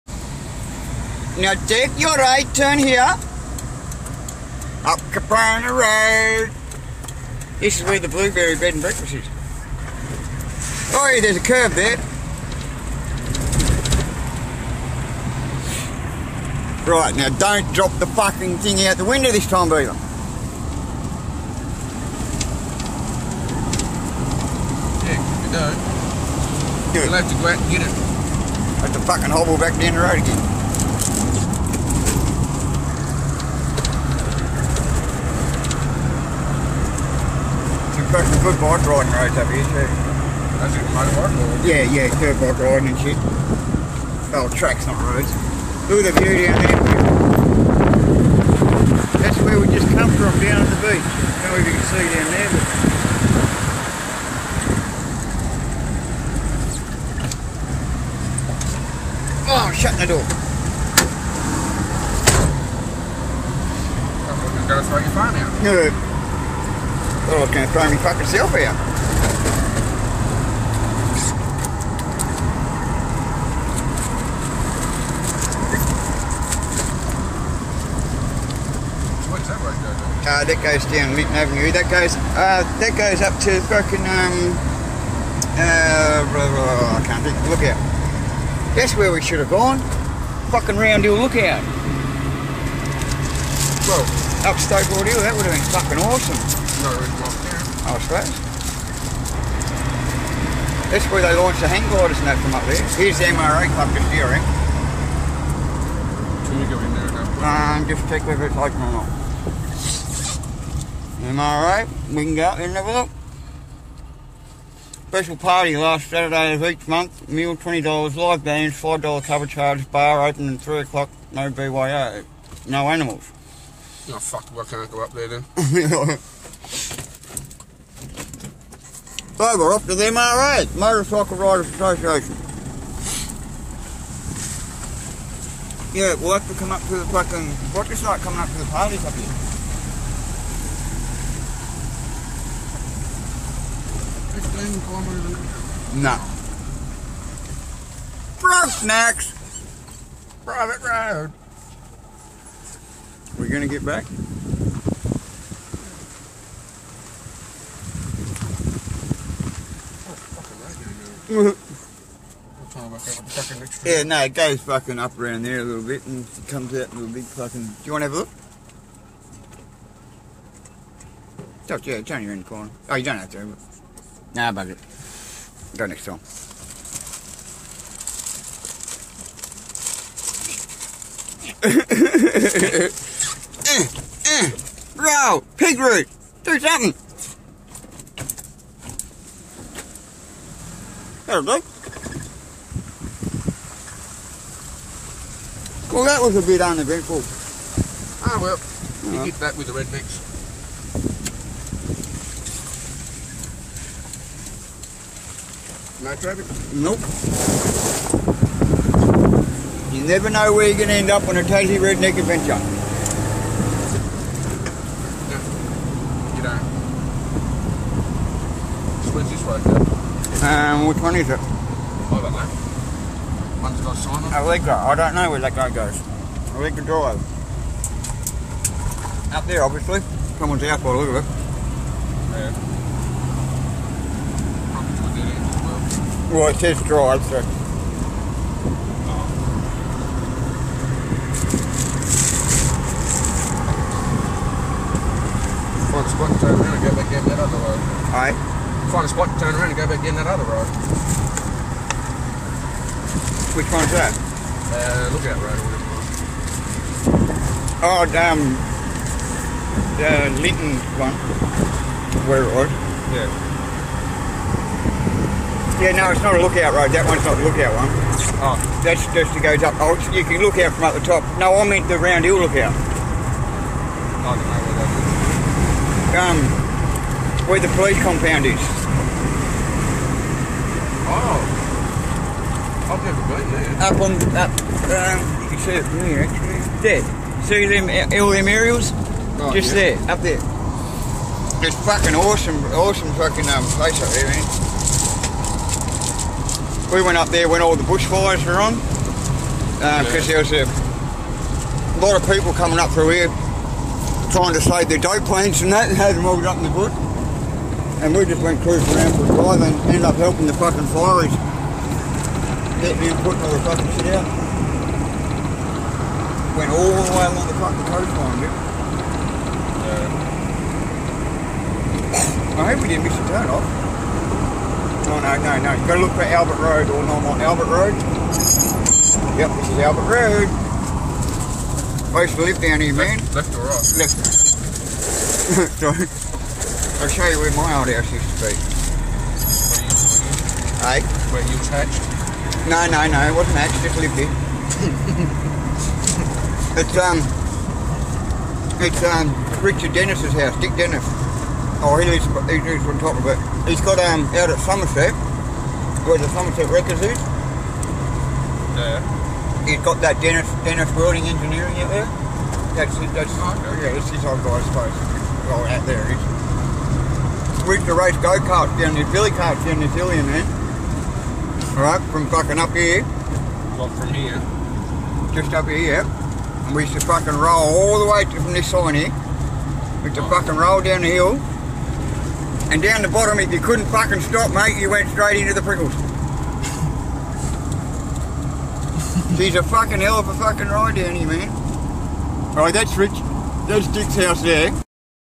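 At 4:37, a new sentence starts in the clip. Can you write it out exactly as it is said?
Um, where the police compound is.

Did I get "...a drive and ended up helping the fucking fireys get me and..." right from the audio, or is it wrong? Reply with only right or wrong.
right.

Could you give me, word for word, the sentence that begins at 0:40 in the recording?
That's it, motorbike Yeah, yeah, dirt bike riding and shit.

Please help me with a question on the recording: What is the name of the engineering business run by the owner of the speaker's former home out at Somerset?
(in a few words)
Dennis Welding Engineering.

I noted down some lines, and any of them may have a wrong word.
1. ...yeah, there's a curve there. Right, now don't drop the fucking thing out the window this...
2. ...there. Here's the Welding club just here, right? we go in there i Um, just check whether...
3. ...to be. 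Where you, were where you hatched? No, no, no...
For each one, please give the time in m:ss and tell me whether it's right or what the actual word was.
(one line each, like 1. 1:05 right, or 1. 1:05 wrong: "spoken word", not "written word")
1. 0:11 right
2. 1:42 wrong: "MRA", not "Welding"
3. 5:38 right.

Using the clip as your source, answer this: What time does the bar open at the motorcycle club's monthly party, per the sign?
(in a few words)
3 o'clock.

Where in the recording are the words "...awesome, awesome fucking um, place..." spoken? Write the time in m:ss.
4:52.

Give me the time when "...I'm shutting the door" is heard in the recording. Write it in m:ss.
0:59.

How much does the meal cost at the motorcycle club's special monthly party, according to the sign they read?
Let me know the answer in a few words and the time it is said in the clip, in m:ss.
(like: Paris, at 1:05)
$20, at 1:57.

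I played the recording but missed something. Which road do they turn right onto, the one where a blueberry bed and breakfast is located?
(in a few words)
Caprona Road.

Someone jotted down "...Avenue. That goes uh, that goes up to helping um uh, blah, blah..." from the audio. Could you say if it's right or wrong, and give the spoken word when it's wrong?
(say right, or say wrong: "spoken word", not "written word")
wrong: "fucking", not "helping".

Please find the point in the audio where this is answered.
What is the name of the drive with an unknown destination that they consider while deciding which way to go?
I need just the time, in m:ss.
3:46.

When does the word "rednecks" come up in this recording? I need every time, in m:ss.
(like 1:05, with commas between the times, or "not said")
3:19, 3:31.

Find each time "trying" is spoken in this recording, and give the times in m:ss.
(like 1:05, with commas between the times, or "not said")
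5:04.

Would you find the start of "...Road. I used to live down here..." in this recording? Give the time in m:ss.
5:30.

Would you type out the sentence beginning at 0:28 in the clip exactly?
Have to fucking hobble back down the road again.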